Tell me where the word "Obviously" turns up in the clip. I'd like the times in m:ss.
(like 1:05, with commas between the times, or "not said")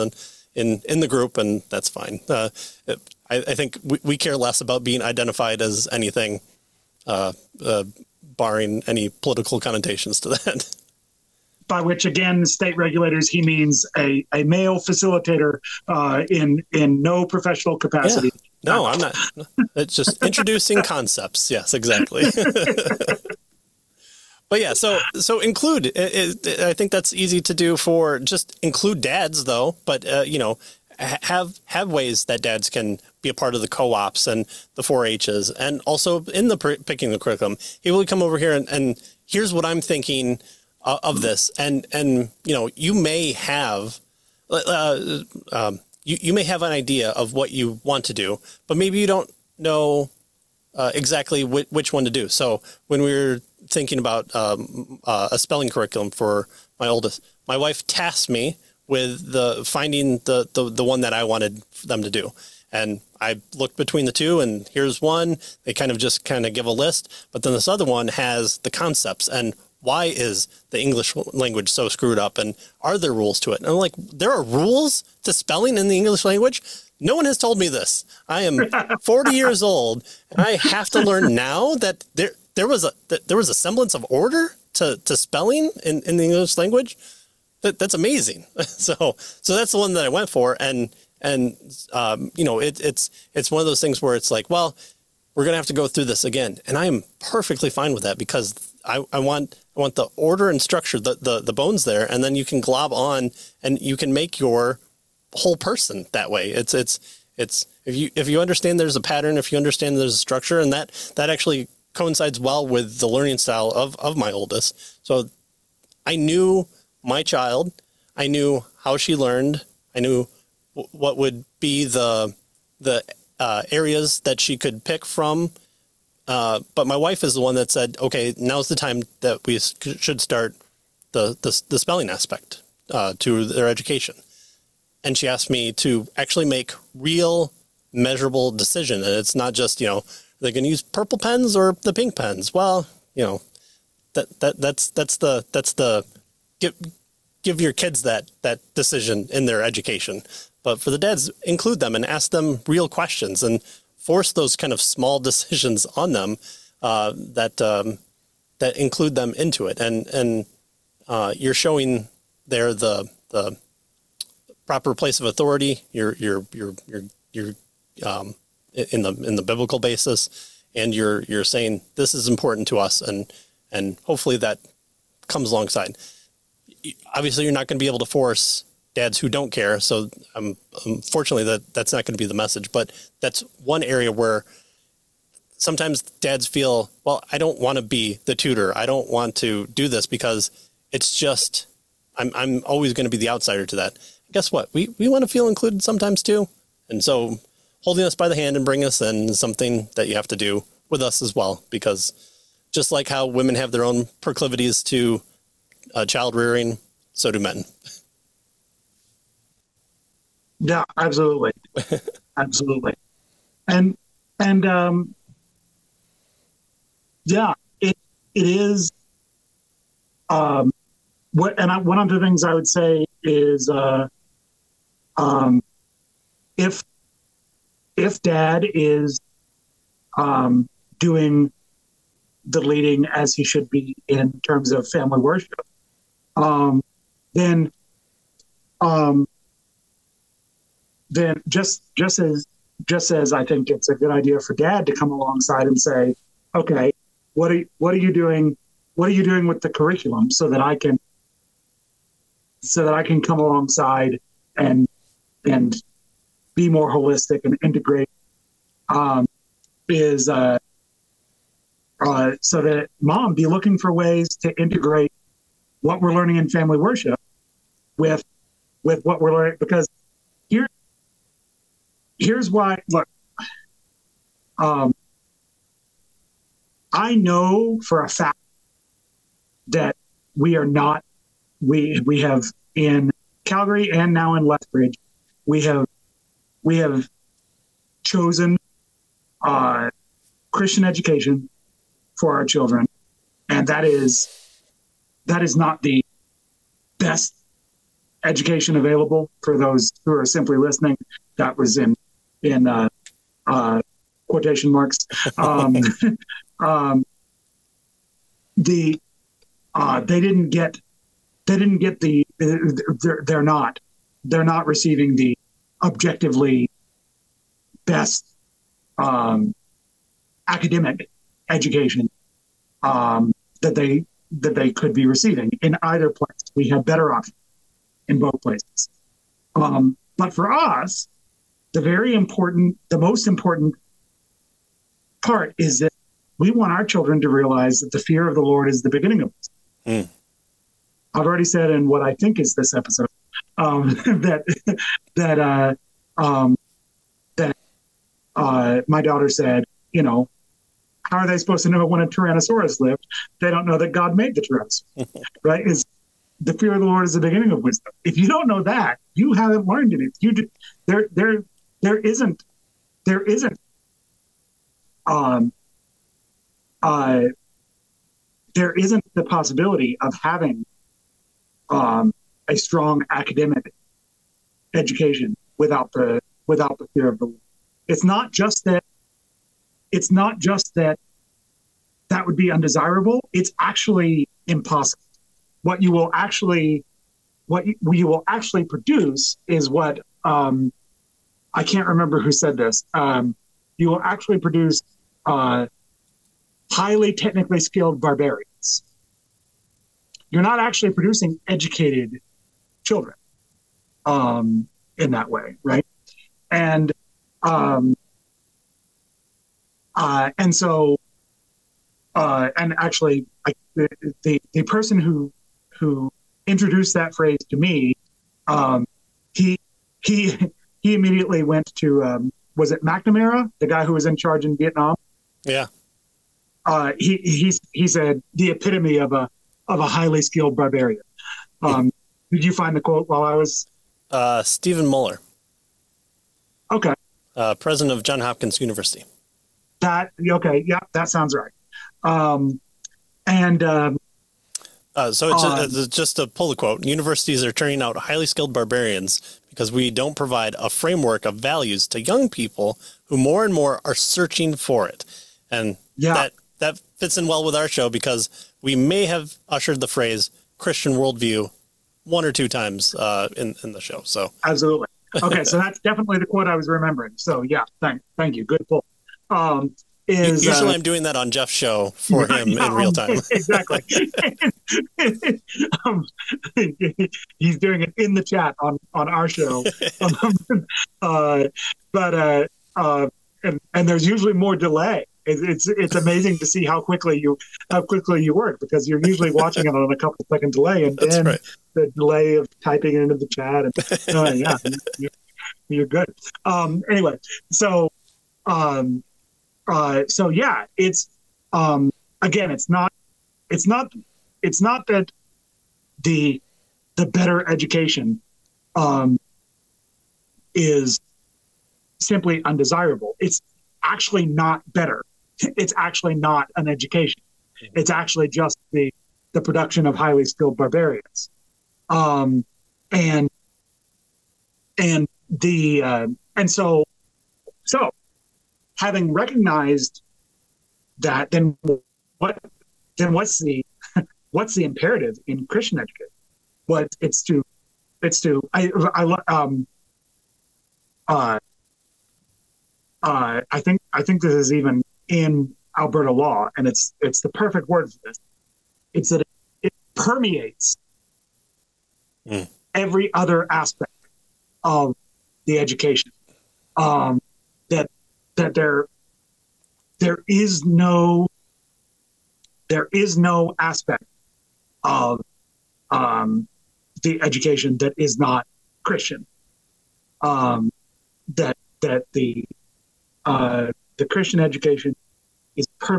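2:57.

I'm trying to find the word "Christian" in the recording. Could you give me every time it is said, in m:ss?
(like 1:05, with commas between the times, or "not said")
4:50, 7:40, 8:55, 9:28, 9:34.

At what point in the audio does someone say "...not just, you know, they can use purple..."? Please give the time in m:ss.
2:19.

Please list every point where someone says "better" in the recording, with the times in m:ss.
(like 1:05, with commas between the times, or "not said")
5:26, 8:27, 8:34.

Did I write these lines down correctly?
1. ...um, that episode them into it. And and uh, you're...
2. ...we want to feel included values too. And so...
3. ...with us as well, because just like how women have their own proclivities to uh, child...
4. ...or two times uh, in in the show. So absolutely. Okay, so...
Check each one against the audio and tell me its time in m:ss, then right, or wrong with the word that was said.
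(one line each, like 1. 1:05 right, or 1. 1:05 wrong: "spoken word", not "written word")
1. 2:37 wrong: "include", not "episode"
2. 3:14 wrong: "sometimes", not "values"
3. 3:20 right
4. 7:42 right.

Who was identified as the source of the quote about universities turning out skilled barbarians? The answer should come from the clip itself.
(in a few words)
Stephen Muller.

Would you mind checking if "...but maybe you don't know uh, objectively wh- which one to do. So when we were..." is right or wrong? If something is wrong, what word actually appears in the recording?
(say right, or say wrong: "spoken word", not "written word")
wrong: "exactly", not "objectively".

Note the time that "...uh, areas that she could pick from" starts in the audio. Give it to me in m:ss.
2:03.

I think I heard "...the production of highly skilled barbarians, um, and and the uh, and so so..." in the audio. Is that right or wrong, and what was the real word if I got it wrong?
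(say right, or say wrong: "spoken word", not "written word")
right.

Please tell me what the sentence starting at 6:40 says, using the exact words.
You're not actually producing educated children um, in that way, right?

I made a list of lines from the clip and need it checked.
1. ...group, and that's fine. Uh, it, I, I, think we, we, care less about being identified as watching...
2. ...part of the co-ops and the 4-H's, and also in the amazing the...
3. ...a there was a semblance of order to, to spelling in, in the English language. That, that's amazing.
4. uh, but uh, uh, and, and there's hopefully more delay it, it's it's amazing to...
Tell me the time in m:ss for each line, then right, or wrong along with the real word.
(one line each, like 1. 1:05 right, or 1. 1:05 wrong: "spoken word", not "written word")
1. 0:01 wrong: "anything", not "watching"
2. 0:33 wrong: "picking", not "amazing"
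3. 1:22 right
4. 8:01 wrong: "usually", not "hopefully".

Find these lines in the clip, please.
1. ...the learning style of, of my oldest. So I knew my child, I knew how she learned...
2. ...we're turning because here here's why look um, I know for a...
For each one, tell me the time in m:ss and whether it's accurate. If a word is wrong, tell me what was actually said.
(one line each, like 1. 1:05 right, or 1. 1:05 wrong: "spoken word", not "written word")
1. 1:52 right
2. 4:29 wrong: "learning", not "turning".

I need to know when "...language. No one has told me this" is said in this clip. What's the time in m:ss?
1:16.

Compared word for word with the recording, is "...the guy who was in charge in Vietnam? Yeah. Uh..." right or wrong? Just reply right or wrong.
right.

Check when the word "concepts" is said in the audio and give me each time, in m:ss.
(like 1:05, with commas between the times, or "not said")
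0:20, 1:08.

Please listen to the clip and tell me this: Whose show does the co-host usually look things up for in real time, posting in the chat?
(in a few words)
Jeff's.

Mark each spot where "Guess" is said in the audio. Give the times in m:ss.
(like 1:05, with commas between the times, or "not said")
3:14.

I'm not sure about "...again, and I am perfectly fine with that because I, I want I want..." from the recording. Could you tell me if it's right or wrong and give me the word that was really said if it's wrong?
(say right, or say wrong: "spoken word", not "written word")
right.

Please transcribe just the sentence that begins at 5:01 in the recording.
That was in in uh, uh, quotation marks.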